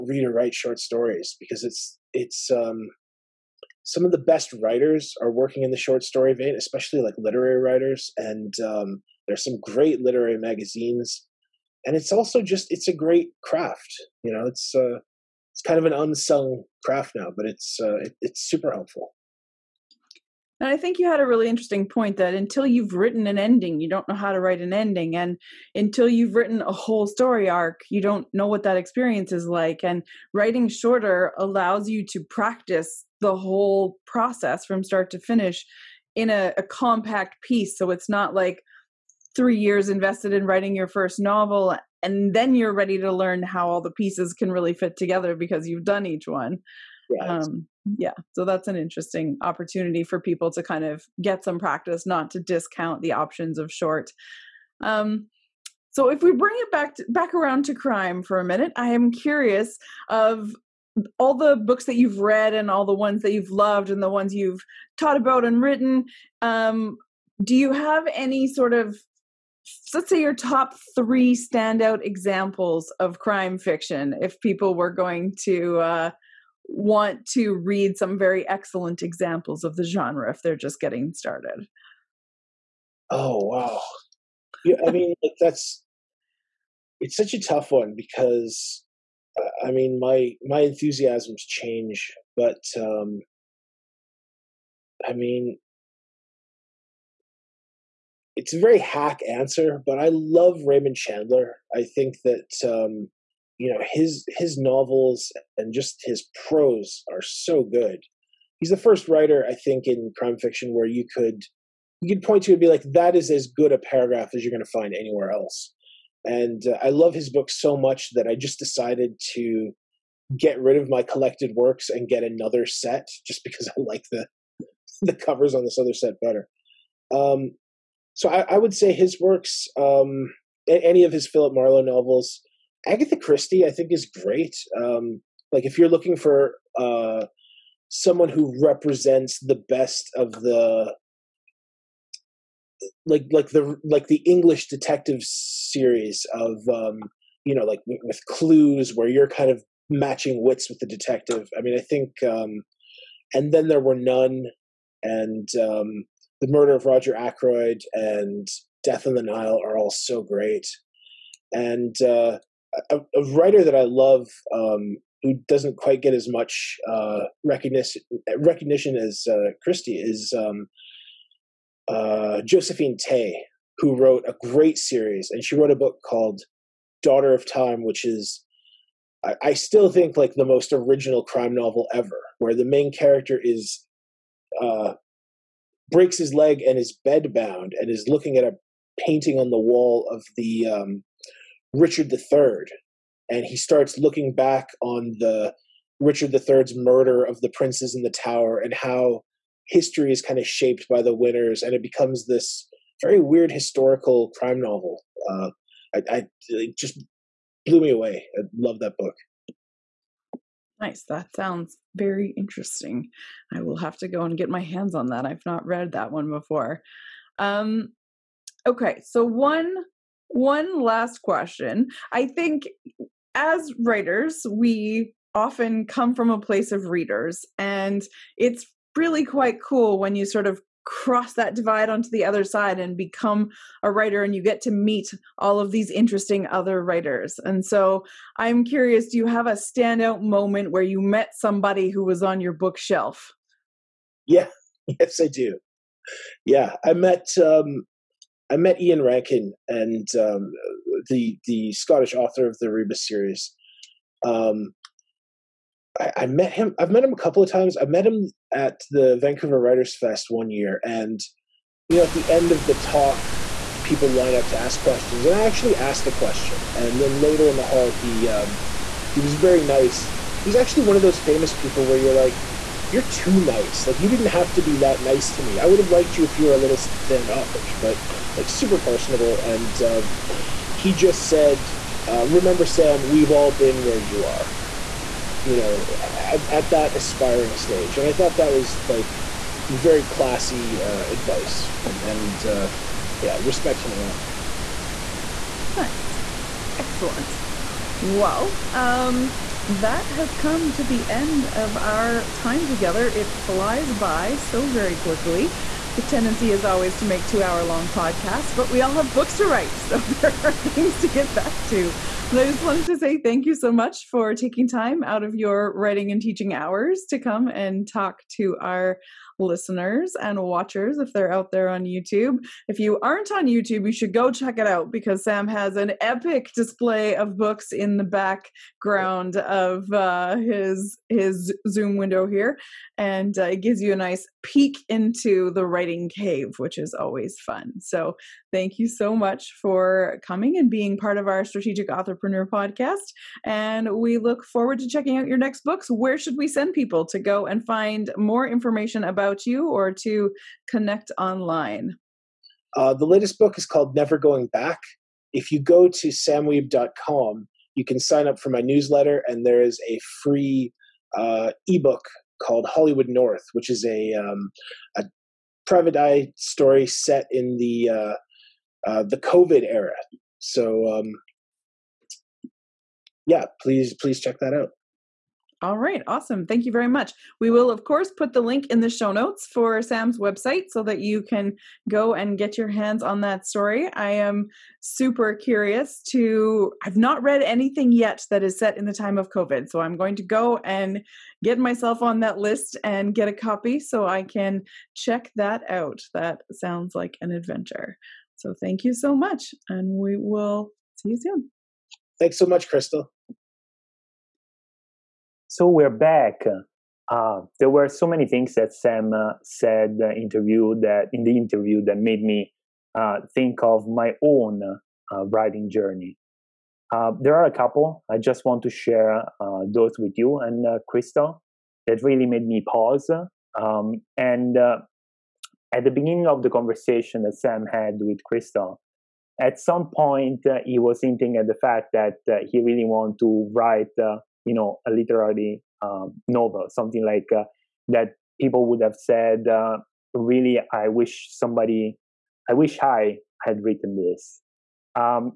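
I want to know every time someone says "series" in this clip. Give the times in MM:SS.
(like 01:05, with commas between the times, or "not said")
02:25, 02:54, 04:13.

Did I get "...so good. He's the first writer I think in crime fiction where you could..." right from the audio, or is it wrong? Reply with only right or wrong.
right.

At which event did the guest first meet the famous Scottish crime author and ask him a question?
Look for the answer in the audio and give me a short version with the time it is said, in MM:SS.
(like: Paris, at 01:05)
Vancouver Writers Fest, at 04:19.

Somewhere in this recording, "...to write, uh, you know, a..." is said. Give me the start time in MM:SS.
07:13.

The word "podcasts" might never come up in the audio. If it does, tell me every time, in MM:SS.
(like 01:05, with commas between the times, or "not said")
05:07, 05:42.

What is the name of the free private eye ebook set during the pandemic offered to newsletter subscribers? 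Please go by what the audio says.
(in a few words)
Hollywood North.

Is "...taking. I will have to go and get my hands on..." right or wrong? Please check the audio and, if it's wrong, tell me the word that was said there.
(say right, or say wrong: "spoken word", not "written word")
wrong: "interesting", not "taking".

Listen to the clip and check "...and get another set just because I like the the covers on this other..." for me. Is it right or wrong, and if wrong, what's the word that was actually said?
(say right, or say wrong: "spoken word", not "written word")
right.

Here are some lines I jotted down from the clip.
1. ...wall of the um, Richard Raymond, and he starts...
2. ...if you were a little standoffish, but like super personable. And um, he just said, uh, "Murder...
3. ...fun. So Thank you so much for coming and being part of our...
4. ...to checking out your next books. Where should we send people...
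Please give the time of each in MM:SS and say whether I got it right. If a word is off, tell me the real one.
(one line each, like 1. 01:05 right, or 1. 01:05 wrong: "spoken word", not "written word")
1. 03:09 wrong: "III", not "Raymond"
2. 04:36 wrong: "Remember", not "Murder"
3. 05:37 right
4. 05:44 right.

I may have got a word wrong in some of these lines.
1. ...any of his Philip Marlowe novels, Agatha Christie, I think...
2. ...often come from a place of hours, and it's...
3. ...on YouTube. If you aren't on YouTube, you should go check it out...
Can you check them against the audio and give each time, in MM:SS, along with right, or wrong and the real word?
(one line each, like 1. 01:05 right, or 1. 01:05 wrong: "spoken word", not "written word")
1. 02:10 right
2. 03:45 wrong: "readers", not "hours"
3. 05:21 right.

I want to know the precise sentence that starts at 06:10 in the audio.
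So, um, yeah, please please check that out.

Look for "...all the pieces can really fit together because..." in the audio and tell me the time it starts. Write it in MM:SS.
00:43.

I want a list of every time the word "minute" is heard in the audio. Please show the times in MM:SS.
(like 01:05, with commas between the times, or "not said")
00:58.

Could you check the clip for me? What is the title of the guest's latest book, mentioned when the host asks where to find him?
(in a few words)
Never Going Back.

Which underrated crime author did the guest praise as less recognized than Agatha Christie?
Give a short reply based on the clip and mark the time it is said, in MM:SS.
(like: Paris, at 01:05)
Josephine Tey, at 02:52.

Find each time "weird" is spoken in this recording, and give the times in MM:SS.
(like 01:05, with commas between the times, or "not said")
03:23.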